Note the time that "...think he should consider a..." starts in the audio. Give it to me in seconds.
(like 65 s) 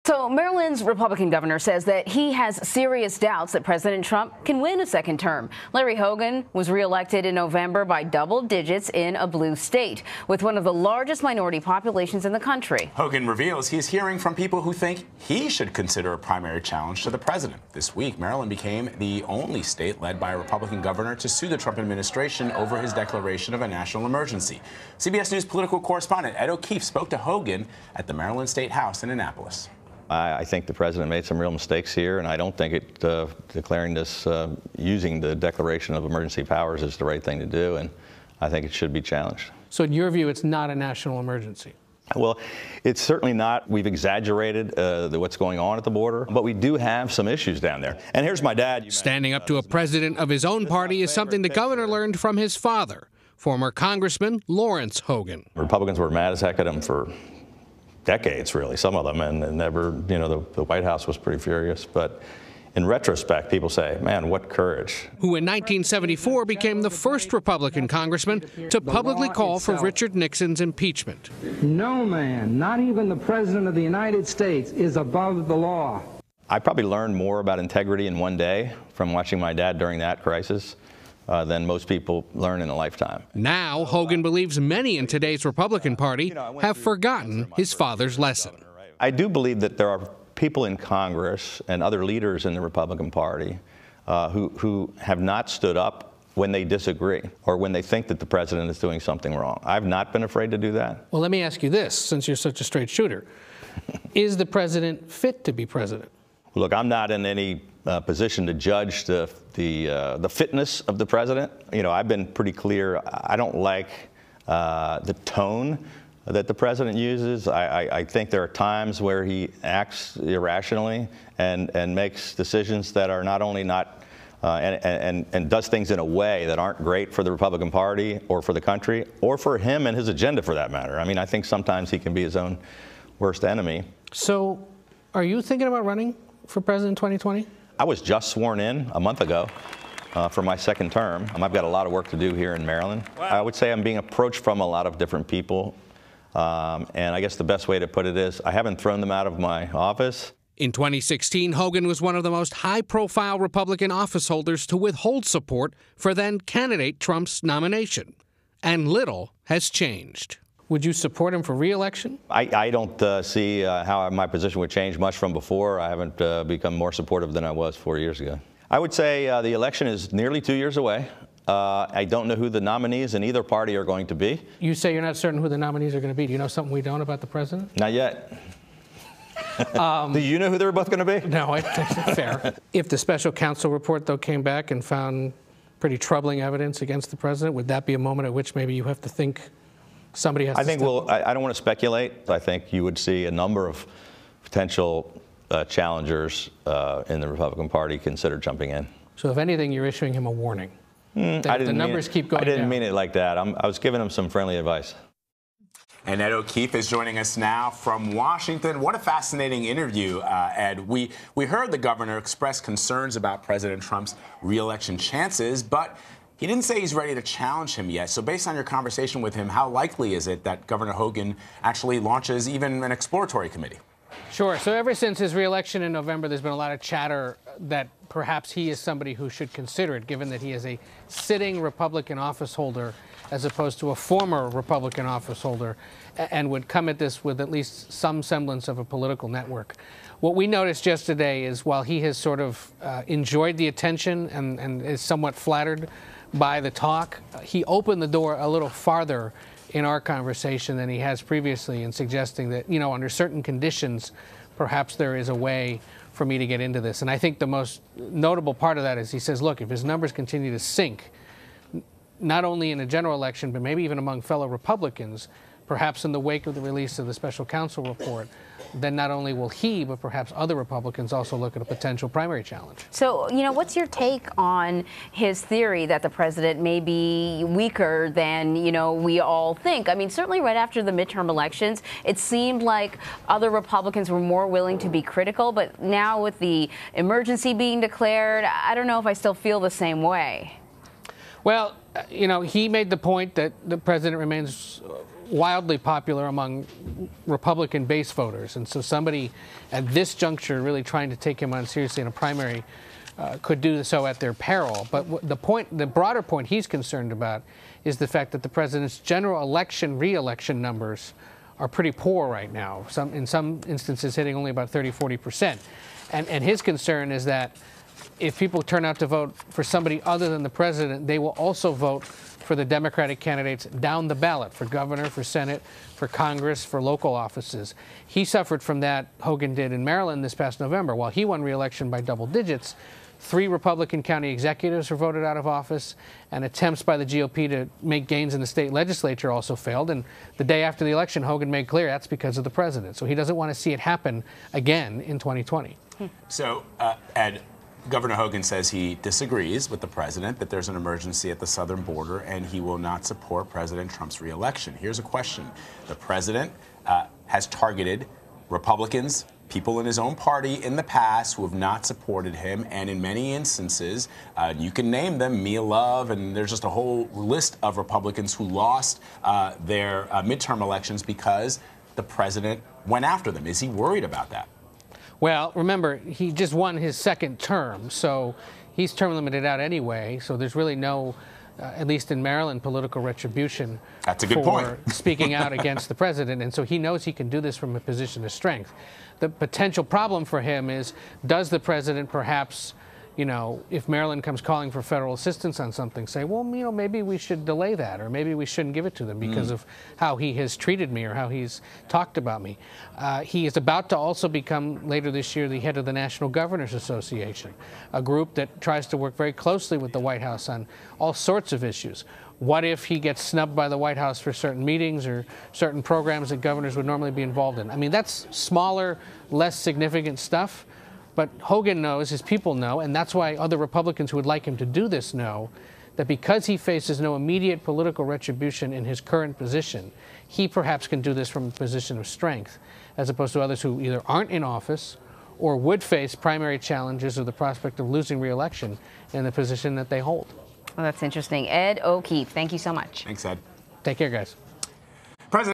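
14 s.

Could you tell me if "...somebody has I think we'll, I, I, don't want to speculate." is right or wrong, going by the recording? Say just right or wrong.
right.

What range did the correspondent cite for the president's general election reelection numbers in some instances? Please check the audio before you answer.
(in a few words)
30 to 40 percent.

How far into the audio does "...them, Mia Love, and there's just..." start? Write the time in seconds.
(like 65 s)
365 s.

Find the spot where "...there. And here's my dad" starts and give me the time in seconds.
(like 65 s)
47 s.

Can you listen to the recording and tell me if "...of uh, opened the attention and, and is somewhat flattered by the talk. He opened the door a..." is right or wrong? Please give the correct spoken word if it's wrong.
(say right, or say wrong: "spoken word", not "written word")
wrong: "enjoyed", not "opened".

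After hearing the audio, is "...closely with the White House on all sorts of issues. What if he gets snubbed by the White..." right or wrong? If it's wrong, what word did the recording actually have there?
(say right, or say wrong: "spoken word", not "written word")
right.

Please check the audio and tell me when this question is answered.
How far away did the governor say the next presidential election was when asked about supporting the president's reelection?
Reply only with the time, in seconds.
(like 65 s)
170 s.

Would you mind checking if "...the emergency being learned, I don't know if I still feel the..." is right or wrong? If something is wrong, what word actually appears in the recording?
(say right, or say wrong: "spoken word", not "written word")
wrong: "declared", not "learned".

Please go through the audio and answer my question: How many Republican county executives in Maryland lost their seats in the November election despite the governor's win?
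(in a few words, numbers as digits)
3.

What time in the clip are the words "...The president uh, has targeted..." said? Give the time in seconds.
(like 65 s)
355 s.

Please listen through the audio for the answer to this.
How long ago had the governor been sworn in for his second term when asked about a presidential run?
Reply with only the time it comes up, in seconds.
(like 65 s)
138 s.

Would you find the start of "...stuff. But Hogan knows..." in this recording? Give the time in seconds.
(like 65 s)
420 s.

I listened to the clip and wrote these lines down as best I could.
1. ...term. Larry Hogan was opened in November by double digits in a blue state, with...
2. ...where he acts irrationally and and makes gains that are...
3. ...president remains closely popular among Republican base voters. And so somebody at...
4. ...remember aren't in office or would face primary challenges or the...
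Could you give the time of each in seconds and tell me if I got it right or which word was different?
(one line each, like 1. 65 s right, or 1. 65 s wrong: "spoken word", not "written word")
1. 5 s wrong: "reelected", not "opened"
2. 119 s wrong: "decisions", not "gains"
3. 293 s wrong: "wildly", not "closely"
4. 433 s wrong: "either", not "remember".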